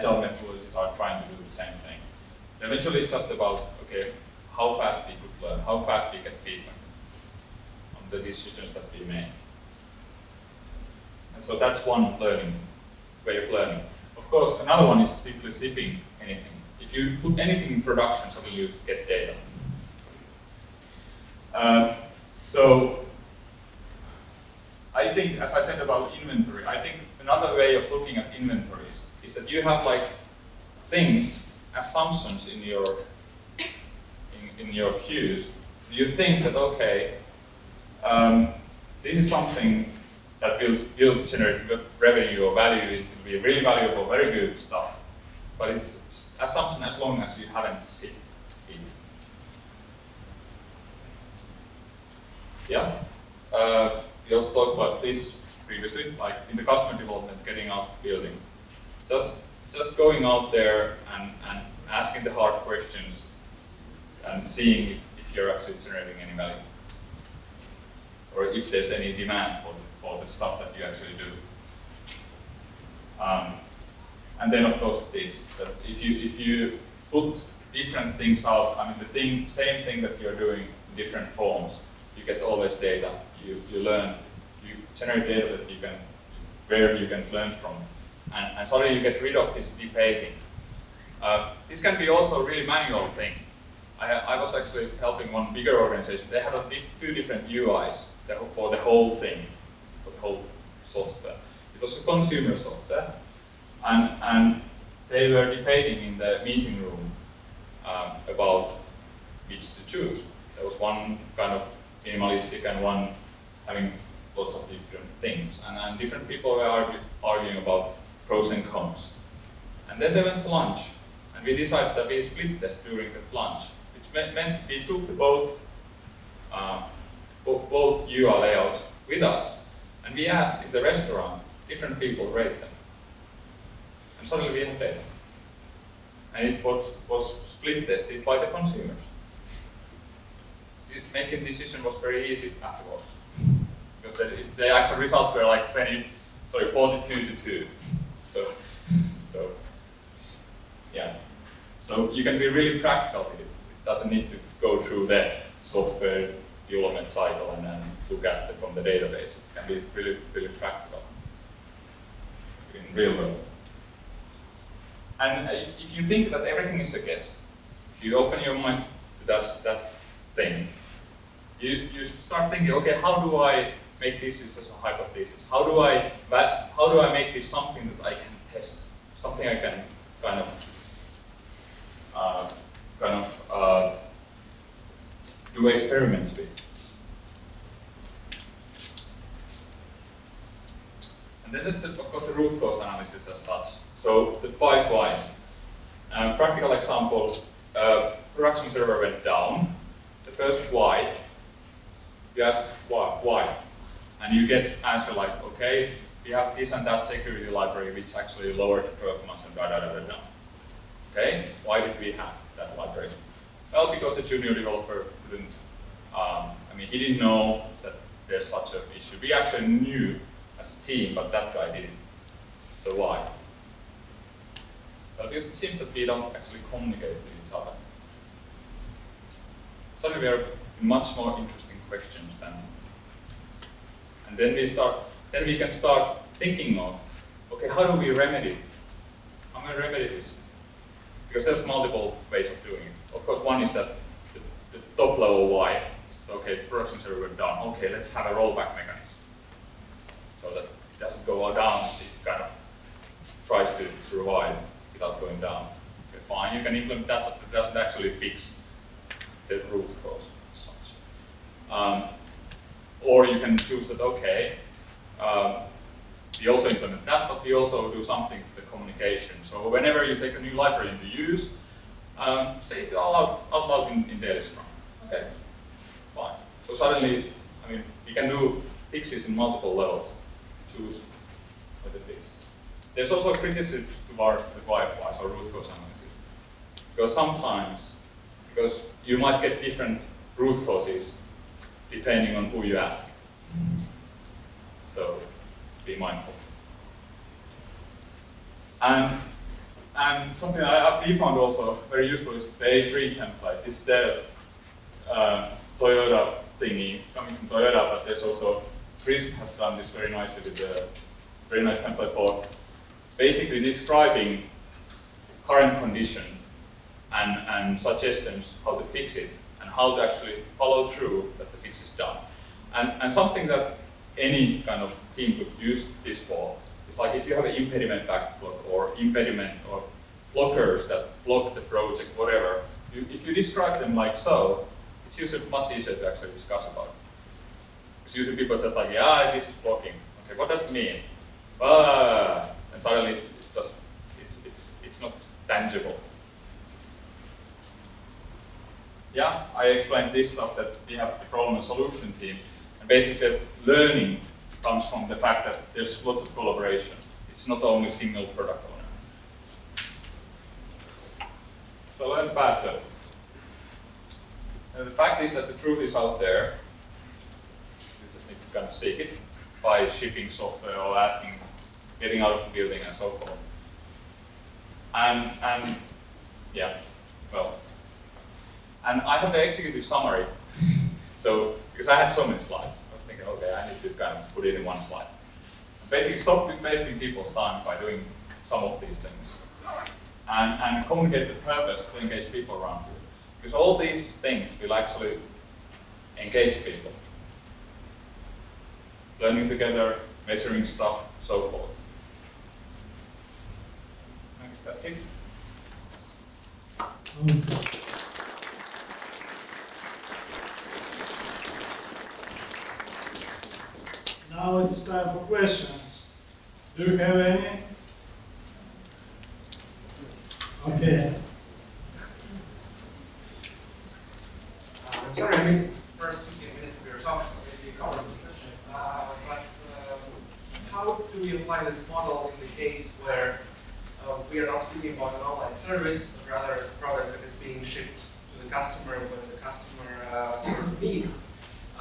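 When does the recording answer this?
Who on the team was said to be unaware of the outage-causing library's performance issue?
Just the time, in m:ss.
3:34.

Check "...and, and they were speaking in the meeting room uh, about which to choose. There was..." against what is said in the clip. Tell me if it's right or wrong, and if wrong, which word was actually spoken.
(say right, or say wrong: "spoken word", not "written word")
wrong: "debating", not "speaking".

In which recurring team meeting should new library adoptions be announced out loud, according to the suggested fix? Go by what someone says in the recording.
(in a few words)
daily scrum.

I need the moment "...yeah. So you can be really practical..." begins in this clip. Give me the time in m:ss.
2:30.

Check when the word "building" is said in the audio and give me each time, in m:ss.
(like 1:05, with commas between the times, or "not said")
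0:58, 6:12.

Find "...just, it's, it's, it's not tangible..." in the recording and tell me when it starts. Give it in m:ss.
5:43.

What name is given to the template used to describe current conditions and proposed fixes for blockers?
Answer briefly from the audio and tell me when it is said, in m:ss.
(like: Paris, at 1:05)
A3, at 5:02.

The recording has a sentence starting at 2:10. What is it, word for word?
And we asked in the restaurant different people rate them suddenly we had data.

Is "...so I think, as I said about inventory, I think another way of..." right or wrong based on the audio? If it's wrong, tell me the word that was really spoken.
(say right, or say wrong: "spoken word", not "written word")
right.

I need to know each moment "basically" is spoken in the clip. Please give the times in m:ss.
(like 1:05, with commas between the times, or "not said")
5:13, 5:52, 6:25.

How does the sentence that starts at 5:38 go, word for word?
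Because usually people just like, yeah, this is blocking.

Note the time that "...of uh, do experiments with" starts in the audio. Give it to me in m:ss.
3:03.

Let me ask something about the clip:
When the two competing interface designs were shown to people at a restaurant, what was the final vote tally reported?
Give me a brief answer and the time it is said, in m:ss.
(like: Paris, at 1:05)
42 to 2, at 2:26.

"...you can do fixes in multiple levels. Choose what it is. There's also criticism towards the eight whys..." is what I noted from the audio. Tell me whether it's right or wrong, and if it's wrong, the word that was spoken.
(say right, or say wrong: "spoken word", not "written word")
wrong: "five", not "eight".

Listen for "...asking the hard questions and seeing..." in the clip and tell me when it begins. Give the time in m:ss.
1:01.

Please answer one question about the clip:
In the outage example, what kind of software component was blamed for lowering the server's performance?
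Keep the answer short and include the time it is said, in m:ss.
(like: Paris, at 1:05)
security library, at 3:27.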